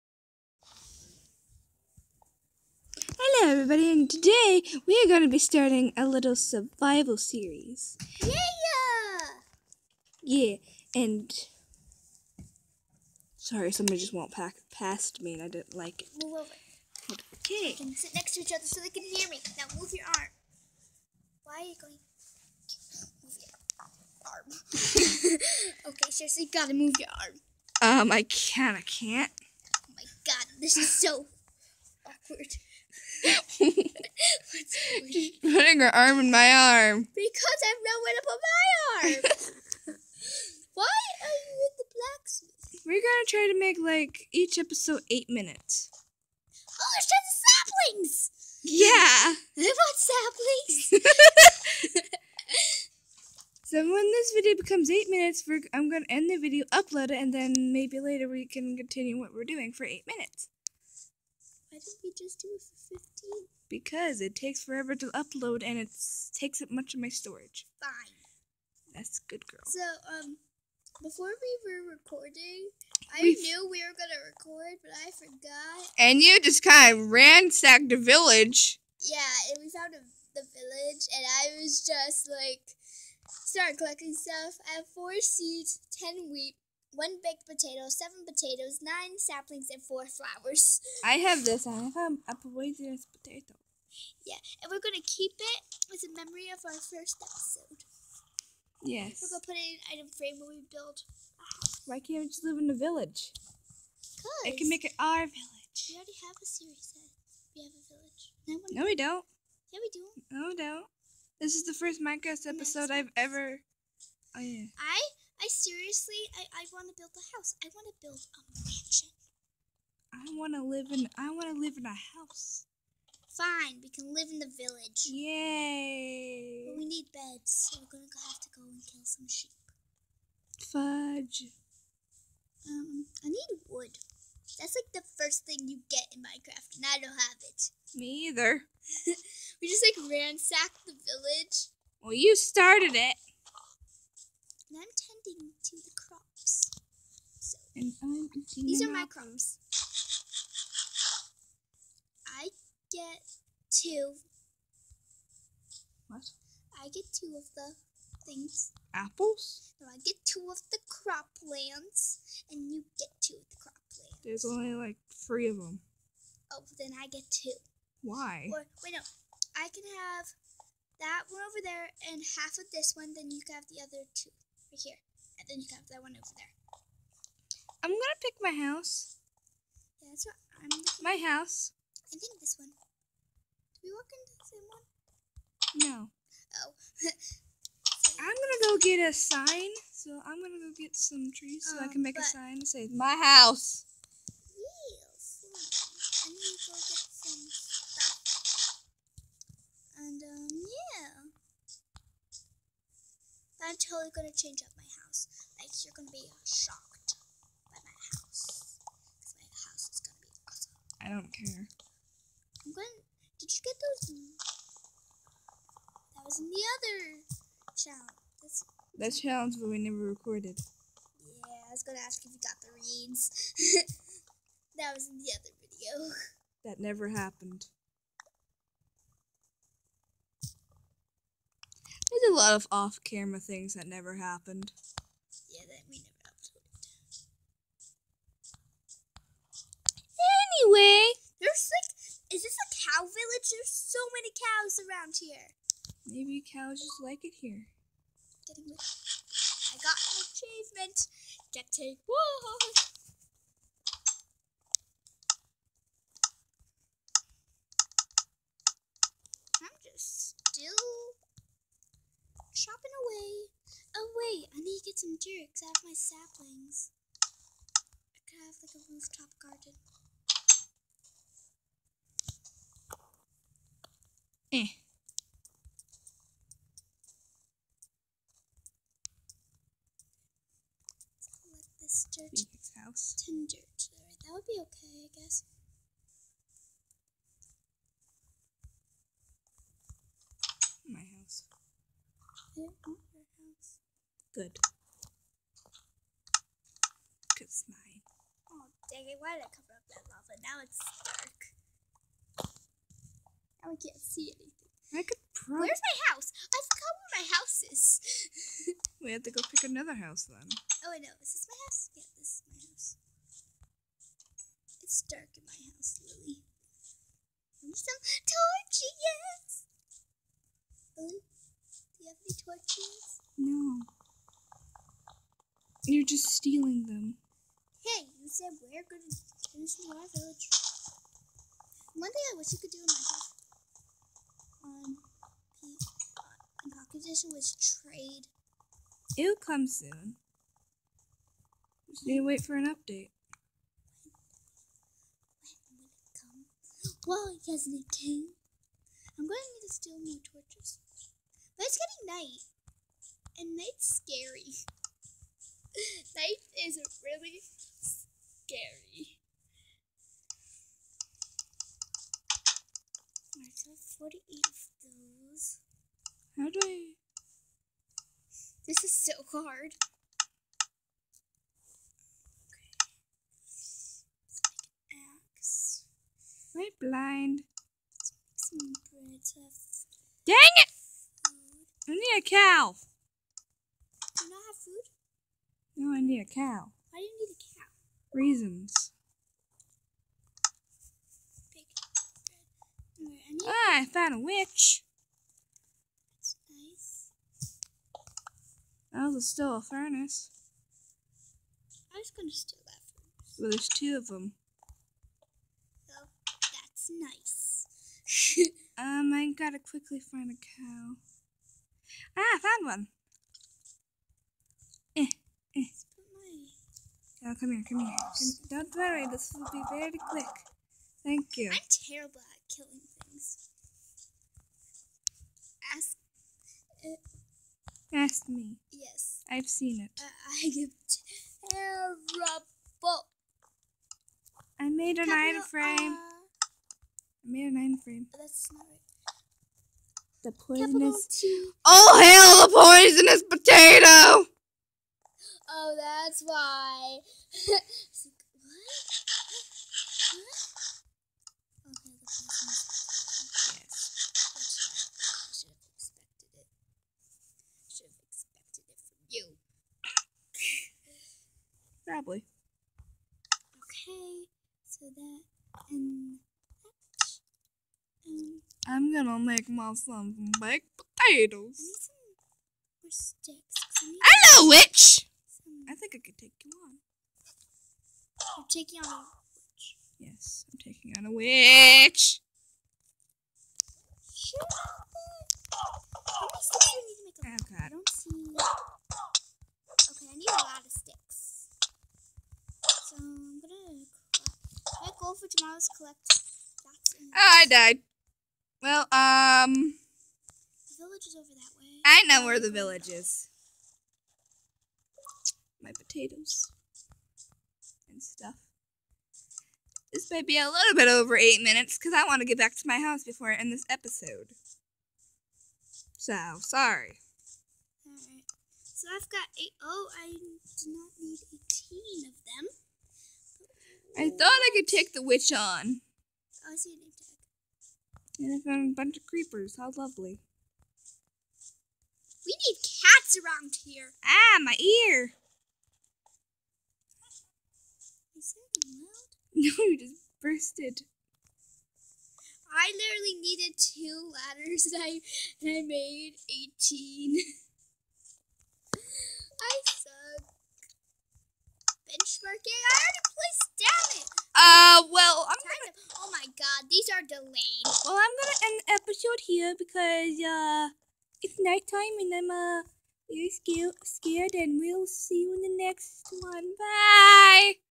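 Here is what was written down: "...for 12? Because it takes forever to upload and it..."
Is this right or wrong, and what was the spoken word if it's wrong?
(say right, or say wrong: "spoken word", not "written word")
wrong: "15", not "12".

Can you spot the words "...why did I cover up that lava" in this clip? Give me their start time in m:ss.
4:59.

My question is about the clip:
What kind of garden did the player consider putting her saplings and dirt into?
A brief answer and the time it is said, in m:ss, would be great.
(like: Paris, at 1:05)
rooftop garden, at 4:28.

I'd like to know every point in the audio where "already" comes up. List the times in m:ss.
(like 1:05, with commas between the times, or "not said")
1:45, 9:12.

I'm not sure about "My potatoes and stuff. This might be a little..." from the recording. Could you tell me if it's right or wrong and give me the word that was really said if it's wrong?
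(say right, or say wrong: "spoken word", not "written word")
right.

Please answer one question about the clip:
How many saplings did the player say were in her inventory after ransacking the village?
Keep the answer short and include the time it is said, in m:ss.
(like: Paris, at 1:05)
9, at 1:28.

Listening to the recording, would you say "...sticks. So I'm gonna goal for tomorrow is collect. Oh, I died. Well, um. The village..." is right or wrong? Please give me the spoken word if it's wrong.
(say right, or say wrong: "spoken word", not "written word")
right.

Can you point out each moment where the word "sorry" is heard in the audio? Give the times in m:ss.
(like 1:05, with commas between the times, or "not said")
0:13, 8:36.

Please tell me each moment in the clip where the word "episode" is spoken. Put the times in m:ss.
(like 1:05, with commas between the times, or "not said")
0:44, 1:37, 1:52, 8:33, 9:18.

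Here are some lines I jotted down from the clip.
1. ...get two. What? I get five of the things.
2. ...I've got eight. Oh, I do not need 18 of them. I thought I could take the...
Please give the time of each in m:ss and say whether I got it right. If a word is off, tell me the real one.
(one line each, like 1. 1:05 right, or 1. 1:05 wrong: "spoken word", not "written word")
1. 2:32 wrong: "two", not "five"
2. 8:38 right.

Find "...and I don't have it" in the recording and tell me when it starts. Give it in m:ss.
2:16.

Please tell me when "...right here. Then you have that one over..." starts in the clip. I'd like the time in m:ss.
2:54.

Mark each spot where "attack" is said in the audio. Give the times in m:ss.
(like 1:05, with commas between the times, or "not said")
8:46.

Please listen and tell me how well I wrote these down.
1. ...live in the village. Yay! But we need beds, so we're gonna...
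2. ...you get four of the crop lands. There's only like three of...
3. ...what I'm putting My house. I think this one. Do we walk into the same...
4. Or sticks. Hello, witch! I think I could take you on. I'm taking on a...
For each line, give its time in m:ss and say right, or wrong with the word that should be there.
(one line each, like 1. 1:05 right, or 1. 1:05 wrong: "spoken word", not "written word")
1. 2:04 right
2. 2:42 wrong: "two", not "four"
3. 3:00 wrong: "looking", not "putting"
4. 7:52 right.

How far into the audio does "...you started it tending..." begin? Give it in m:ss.
2:22.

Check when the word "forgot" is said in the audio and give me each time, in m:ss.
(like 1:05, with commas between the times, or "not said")
1:15, 5:06.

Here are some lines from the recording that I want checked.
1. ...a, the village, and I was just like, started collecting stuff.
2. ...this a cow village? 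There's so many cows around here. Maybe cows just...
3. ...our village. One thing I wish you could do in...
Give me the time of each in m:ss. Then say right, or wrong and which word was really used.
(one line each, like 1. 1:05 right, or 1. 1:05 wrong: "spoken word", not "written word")
1. 1:19 right
2. 4:02 right
3. 5:29 right.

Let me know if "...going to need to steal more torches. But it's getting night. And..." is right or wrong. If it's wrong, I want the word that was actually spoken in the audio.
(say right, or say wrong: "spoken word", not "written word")
right.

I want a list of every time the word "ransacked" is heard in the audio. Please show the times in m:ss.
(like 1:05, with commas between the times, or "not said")
1:17, 2:20.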